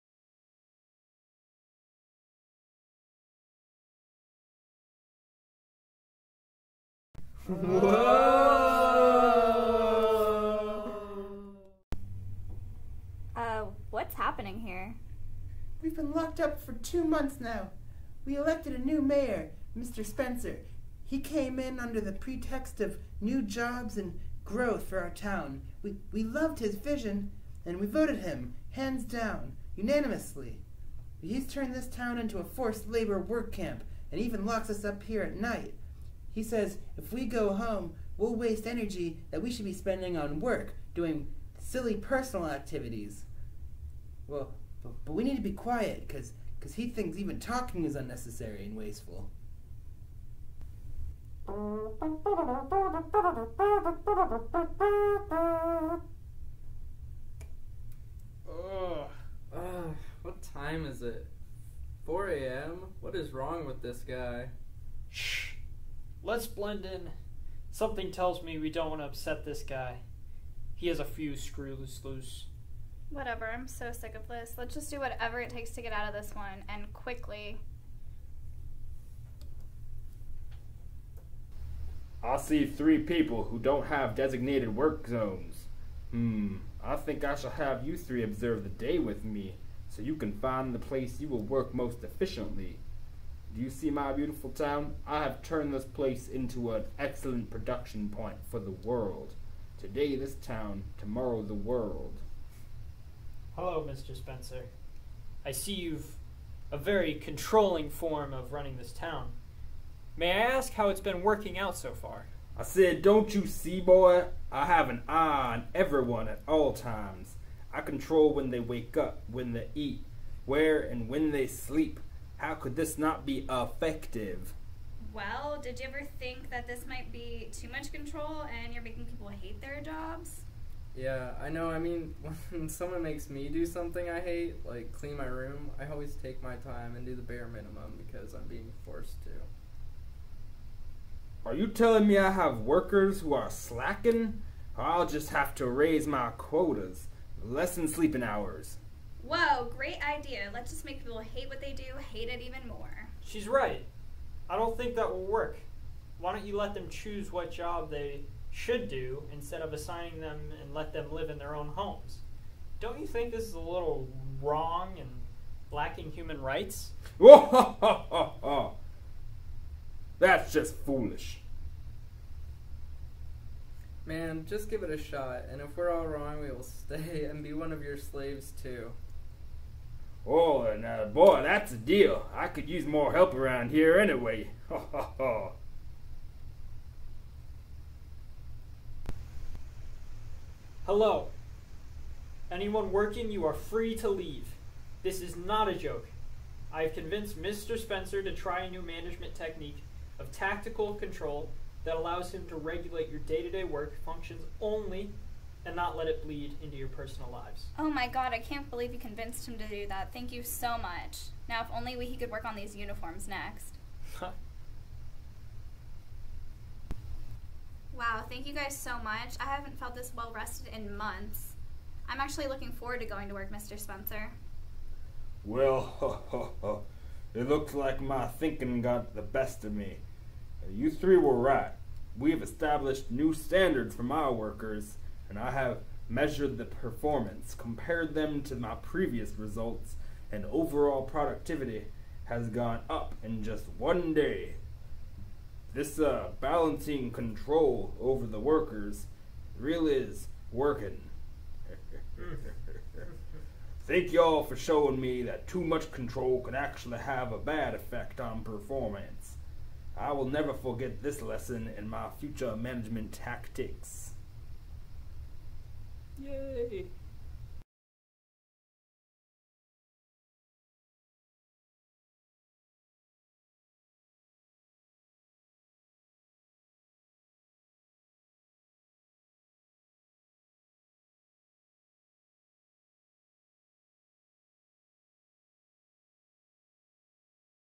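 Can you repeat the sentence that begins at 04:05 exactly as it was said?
This uh, balancing control over the workers really is working.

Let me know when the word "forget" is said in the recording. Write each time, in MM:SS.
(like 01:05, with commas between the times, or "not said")
04:20.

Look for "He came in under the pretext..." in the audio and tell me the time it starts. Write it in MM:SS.
00:21.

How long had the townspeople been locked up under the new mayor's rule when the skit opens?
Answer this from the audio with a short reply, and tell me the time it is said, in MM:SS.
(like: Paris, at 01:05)
2 months, at 00:16.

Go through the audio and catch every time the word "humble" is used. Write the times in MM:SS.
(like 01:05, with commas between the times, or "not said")
not said.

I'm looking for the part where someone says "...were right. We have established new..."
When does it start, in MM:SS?
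03:51.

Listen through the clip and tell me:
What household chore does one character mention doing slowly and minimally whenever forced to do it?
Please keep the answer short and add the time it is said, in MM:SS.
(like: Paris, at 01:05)
Clean my room, at 02:14.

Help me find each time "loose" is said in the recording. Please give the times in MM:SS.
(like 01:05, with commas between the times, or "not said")
01:12.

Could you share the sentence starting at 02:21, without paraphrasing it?
Are you telling me I have workers who are slacking?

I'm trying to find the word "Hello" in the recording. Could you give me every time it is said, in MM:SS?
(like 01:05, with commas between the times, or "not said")
01:43, 03:10.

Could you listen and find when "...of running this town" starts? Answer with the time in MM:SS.
01:48.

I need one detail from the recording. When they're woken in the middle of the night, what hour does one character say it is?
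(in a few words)
4 a.m.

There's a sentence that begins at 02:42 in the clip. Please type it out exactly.
Don't you think this is a little wrong and lacking human rights?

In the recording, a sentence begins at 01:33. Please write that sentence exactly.
Do you see my beautiful town?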